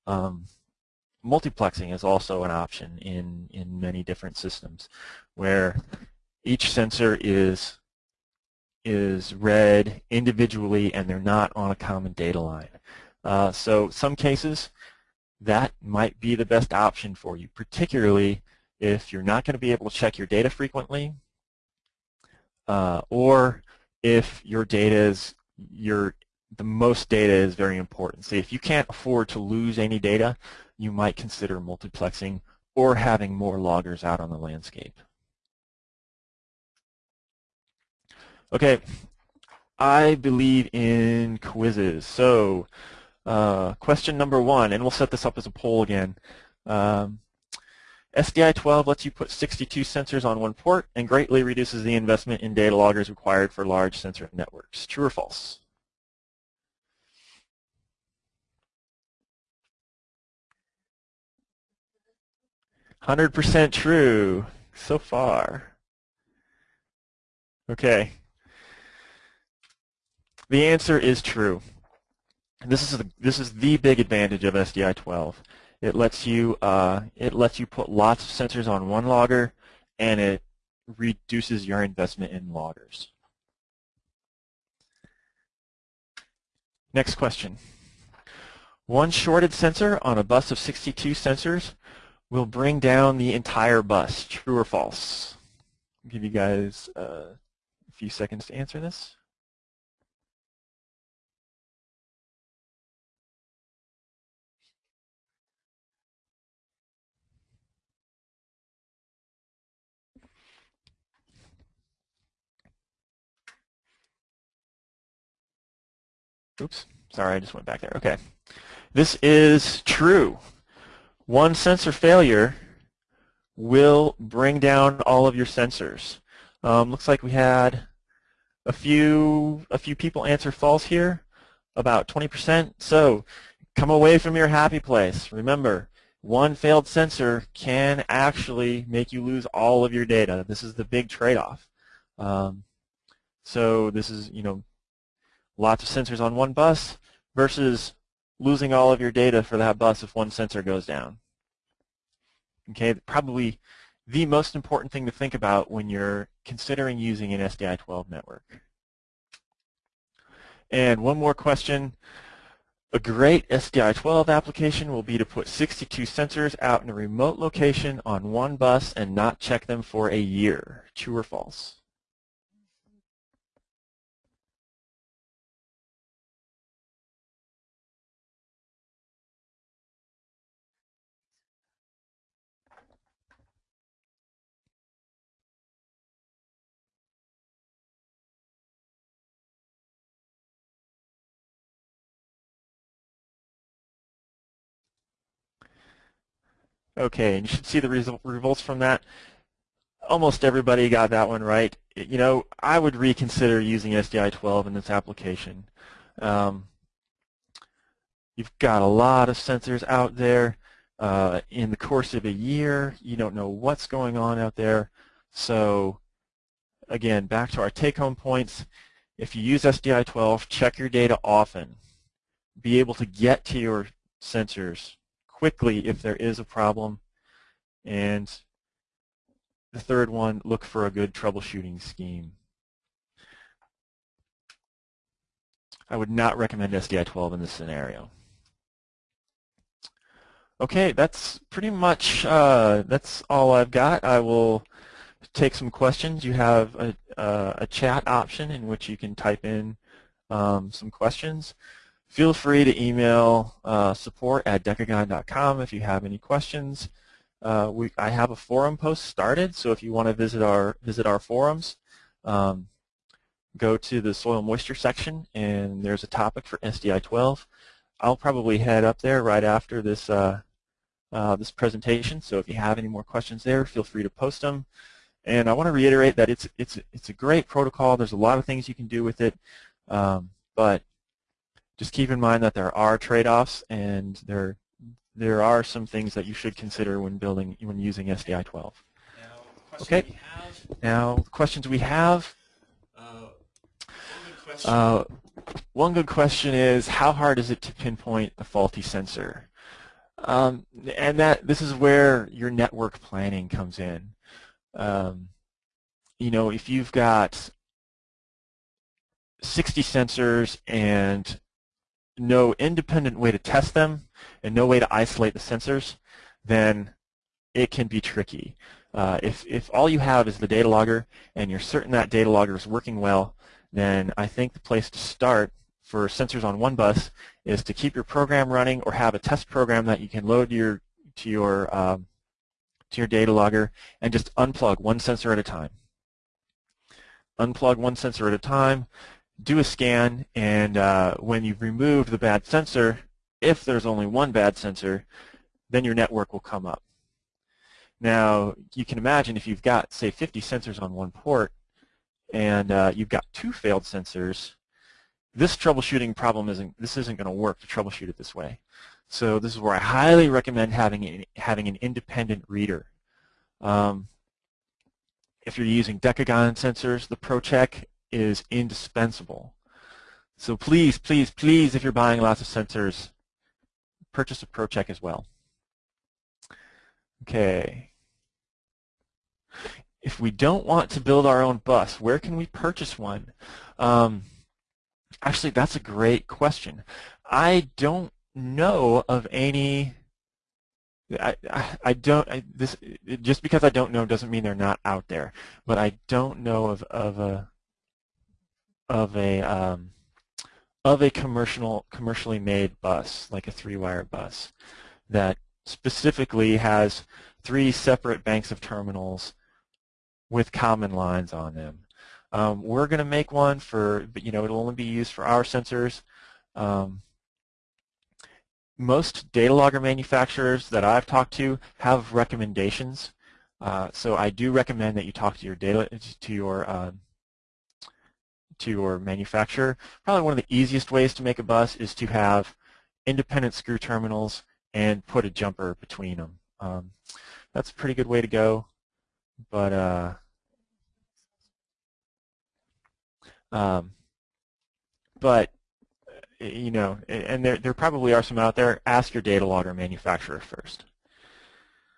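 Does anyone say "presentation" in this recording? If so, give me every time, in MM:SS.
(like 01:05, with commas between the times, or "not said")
04:31.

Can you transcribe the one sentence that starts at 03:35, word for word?
So again, back to our take-home points.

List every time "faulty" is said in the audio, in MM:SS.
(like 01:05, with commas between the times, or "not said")
04:58.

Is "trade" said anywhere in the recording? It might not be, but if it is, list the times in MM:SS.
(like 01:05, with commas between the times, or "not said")
02:21, 04:42.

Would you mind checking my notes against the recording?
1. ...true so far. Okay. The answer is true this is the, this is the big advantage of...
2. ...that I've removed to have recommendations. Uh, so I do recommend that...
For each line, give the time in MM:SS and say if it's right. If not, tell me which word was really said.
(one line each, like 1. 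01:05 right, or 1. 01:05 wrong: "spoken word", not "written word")
1. 01:03 right
2. 07:00 wrong: "talked", not "removed".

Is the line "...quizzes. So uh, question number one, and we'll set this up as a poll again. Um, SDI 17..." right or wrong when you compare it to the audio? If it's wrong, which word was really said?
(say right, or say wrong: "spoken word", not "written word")
wrong: "12", not "17".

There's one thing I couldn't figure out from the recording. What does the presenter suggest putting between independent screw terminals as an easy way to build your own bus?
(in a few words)
a jumper.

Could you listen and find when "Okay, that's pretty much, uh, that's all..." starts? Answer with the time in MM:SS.
04:00.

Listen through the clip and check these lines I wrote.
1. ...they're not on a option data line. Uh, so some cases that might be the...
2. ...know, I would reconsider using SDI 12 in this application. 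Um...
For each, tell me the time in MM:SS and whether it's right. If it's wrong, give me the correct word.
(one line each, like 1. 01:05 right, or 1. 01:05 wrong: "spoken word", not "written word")
1. 00:11 wrong: "common", not "option"
2. 03:22 right.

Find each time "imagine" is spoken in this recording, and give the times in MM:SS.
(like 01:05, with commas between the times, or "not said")
05:48.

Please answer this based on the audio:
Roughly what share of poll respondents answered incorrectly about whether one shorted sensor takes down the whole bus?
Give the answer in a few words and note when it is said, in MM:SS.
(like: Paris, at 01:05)
20%, at 02:11.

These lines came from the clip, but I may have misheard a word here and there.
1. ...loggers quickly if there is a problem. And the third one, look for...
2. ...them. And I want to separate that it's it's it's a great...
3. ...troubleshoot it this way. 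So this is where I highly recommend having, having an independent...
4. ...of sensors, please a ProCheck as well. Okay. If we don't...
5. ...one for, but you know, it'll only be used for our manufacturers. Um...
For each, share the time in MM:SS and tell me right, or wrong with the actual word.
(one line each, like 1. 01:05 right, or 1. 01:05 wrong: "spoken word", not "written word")
1. 03:44 wrong: "sensors", not "loggers"
2. 04:34 wrong: "reiterate", not "separate"
3. 05:57 right
4. 06:12 wrong: "purchase", not "please"
5. 06:53 wrong: "sensors", not "manufacturers".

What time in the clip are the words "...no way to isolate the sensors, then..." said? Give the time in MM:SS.
05:14.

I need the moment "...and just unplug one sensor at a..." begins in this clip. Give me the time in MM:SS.
05:34.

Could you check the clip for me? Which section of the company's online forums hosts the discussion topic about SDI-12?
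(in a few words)
soil moisture.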